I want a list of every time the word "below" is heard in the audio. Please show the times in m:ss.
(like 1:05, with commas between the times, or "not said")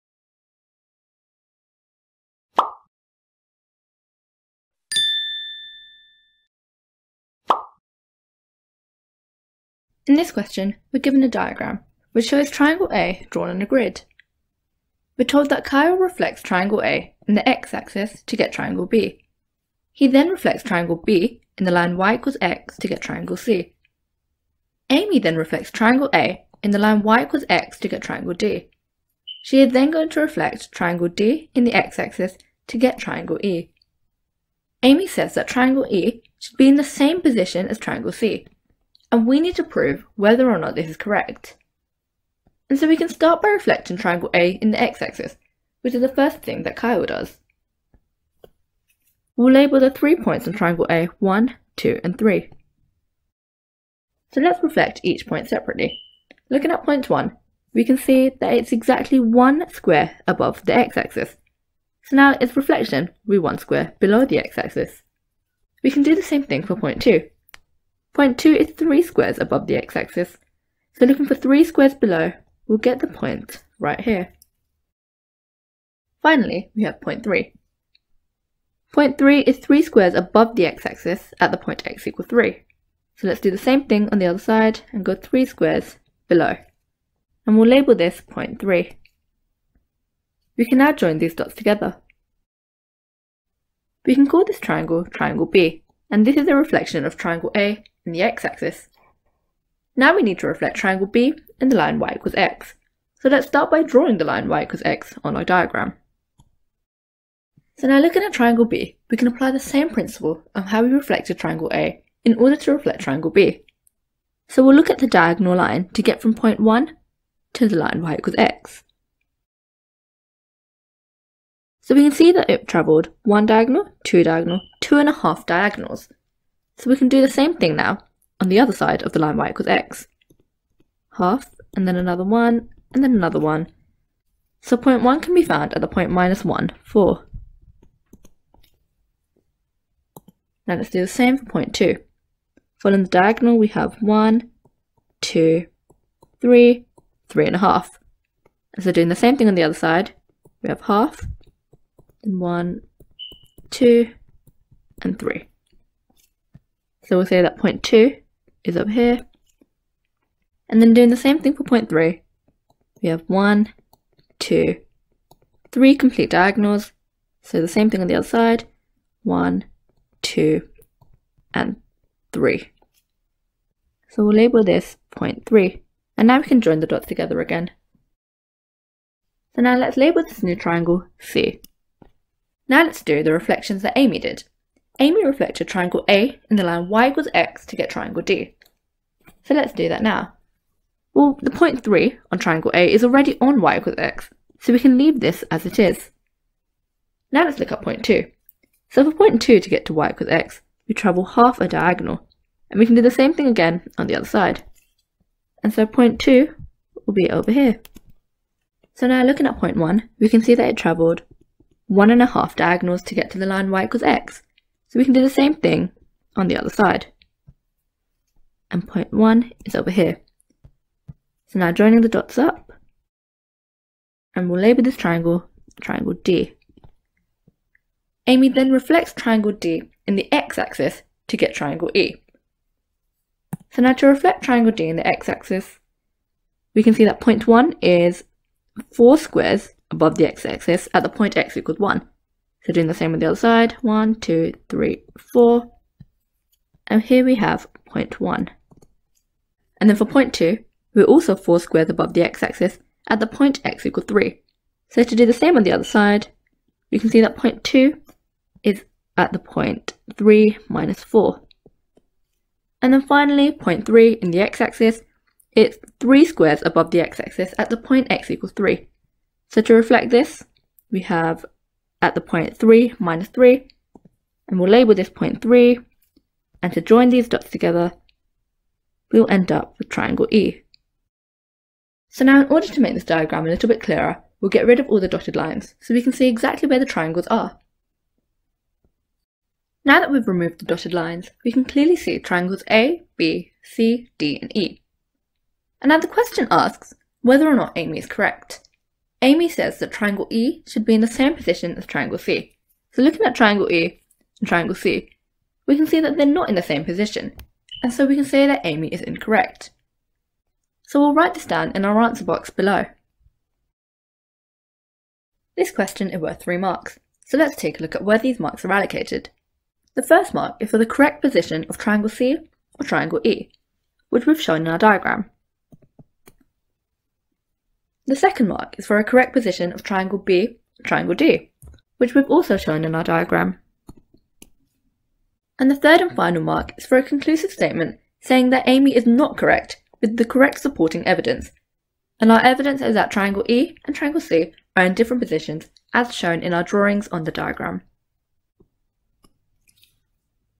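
1:03, 1:11, 1:26, 5:12.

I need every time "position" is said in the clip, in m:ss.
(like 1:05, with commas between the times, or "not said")
0:37, 5:01, 5:06, 5:21, 5:29, 5:45.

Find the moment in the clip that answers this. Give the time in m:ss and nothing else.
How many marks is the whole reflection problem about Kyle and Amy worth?
5:16.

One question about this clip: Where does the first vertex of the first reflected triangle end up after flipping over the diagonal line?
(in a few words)
(-1, 4).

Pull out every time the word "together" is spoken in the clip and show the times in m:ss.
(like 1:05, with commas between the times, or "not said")
1:31, 2:57, 4:37.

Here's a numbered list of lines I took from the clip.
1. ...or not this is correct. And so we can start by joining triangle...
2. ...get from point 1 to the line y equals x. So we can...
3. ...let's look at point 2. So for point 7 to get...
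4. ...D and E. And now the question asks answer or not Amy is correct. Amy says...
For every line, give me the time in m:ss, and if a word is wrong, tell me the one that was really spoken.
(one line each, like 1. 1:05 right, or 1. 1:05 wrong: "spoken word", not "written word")
1. 0:40 wrong: "reflecting", not "joining"
2. 1:56 right
3. 3:17 wrong: "2", not "7"
4. 4:54 wrong: "whether", not "answer".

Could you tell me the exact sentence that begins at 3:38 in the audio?
And point one is over here.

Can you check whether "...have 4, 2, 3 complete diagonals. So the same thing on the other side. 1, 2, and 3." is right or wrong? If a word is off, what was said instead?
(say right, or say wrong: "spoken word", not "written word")
wrong: "1", not "4".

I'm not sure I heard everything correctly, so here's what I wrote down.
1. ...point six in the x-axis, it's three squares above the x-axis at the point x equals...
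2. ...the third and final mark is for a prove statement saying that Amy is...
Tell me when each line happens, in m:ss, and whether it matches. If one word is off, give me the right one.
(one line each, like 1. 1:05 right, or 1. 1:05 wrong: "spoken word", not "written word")
1. 4:23 wrong: "three", not "six"
2. 5:35 wrong: "conclusive", not "prove".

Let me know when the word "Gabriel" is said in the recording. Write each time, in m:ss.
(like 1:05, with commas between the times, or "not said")
not said.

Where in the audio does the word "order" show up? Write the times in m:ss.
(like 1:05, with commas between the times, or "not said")
1:52, 4:42.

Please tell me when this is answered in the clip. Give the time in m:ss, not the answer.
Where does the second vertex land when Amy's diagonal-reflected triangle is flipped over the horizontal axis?
4:20.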